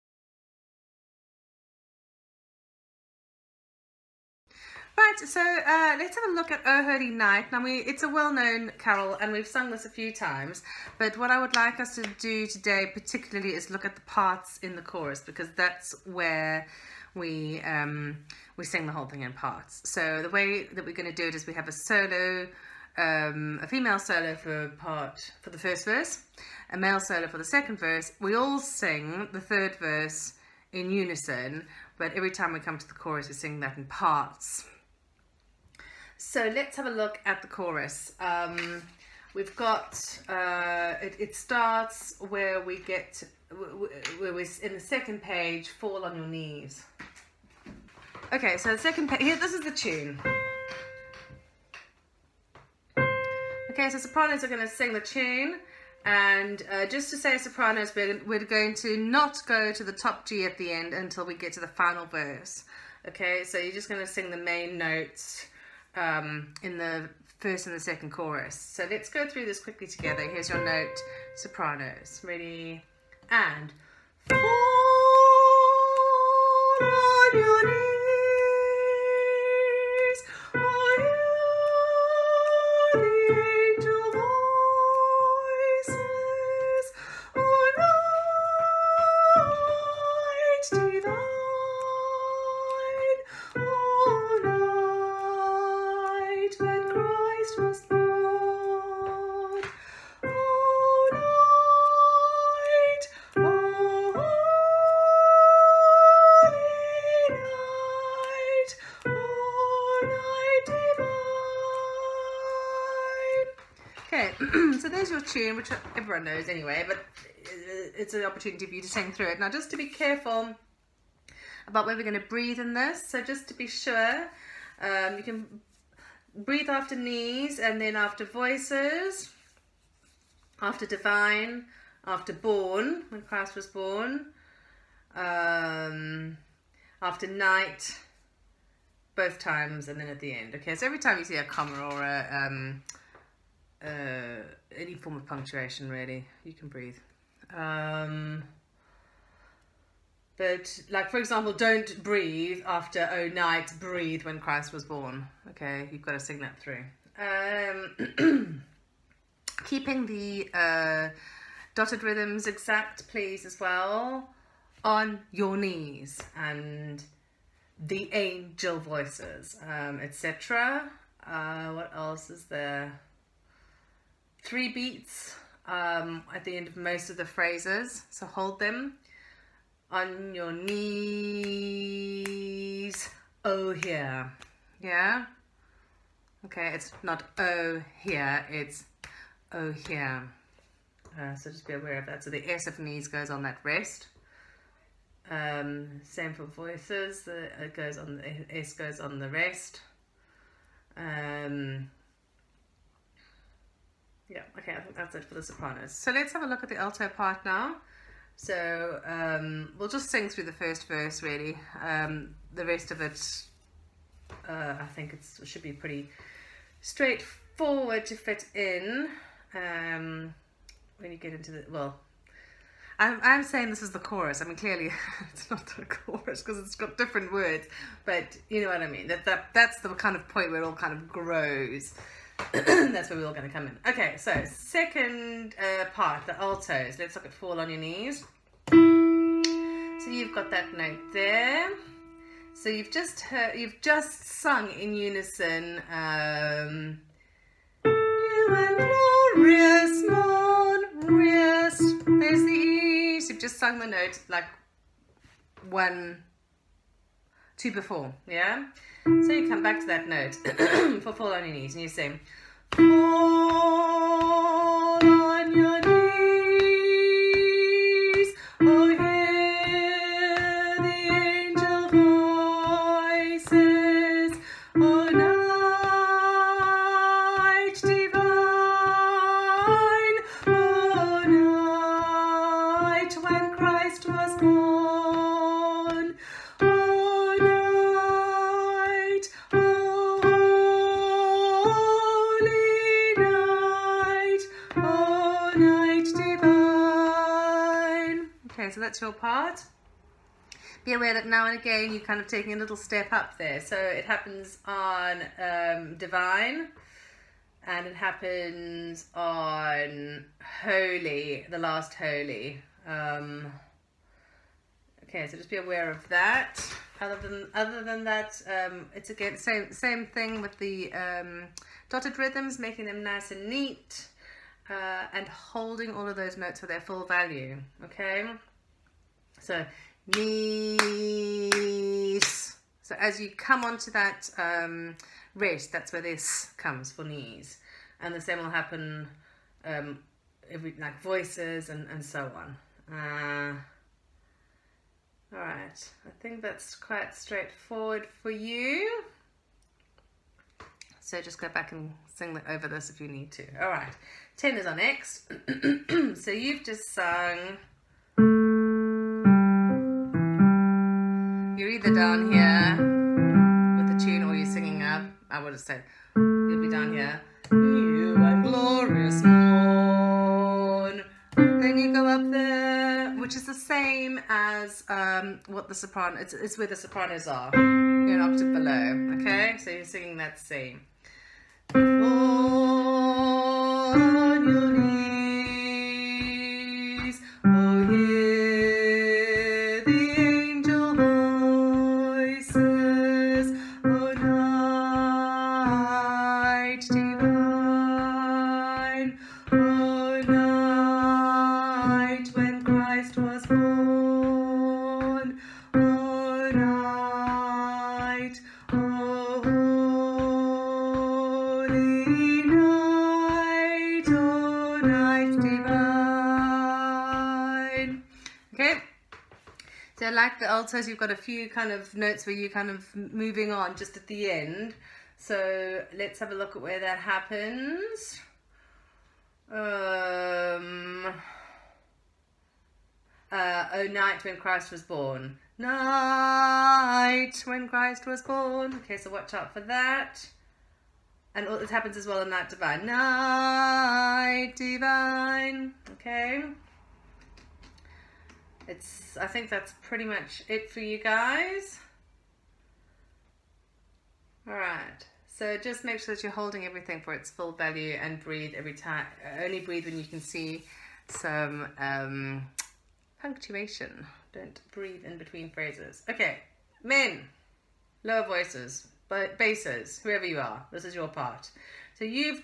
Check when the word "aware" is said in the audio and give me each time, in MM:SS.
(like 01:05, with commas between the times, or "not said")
03:11, 05:00, 05:15.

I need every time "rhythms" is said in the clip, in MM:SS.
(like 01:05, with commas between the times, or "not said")
02:42, 05:22.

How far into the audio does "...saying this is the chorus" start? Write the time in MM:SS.
03:43.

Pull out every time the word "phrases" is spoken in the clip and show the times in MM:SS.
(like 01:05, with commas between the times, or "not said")
02:57, 07:45.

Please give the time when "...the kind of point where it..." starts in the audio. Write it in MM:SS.
03:49.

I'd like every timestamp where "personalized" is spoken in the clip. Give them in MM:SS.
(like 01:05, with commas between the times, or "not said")
not said.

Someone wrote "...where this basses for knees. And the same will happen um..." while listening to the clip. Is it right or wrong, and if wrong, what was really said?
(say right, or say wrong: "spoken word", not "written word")
wrong: "comes", not "basses".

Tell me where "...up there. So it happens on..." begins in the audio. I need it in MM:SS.
05:03.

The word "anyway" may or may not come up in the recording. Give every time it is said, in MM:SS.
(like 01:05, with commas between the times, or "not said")
01:56.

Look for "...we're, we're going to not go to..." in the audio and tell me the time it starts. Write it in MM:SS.
00:57.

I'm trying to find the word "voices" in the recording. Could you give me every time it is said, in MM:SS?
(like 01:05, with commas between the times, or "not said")
02:08, 02:48, 03:16, 05:41, 07:48.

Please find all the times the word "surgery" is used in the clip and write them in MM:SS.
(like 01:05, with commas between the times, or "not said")
not said.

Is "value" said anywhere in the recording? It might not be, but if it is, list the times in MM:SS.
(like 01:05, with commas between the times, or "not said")
05:27, 07:37.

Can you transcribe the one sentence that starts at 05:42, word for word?
Uh, all right, I think that's quite straightforward for you.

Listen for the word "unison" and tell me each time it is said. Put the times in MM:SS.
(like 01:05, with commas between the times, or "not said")
00:30, 04:04.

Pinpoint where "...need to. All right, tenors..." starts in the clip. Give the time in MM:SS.
05:53.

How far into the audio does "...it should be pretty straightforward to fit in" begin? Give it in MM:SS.
03:35.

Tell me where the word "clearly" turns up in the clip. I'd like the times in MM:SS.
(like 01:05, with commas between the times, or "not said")
03:44.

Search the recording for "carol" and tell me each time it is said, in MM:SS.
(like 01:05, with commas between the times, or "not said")
00:08.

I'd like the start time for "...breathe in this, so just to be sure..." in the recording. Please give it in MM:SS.
02:02.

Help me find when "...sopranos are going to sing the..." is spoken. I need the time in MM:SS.
00:53.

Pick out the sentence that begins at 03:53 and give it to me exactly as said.
Okay, so second uh, part, the altos.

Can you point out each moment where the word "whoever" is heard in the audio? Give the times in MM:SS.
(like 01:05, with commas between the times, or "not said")
07:50.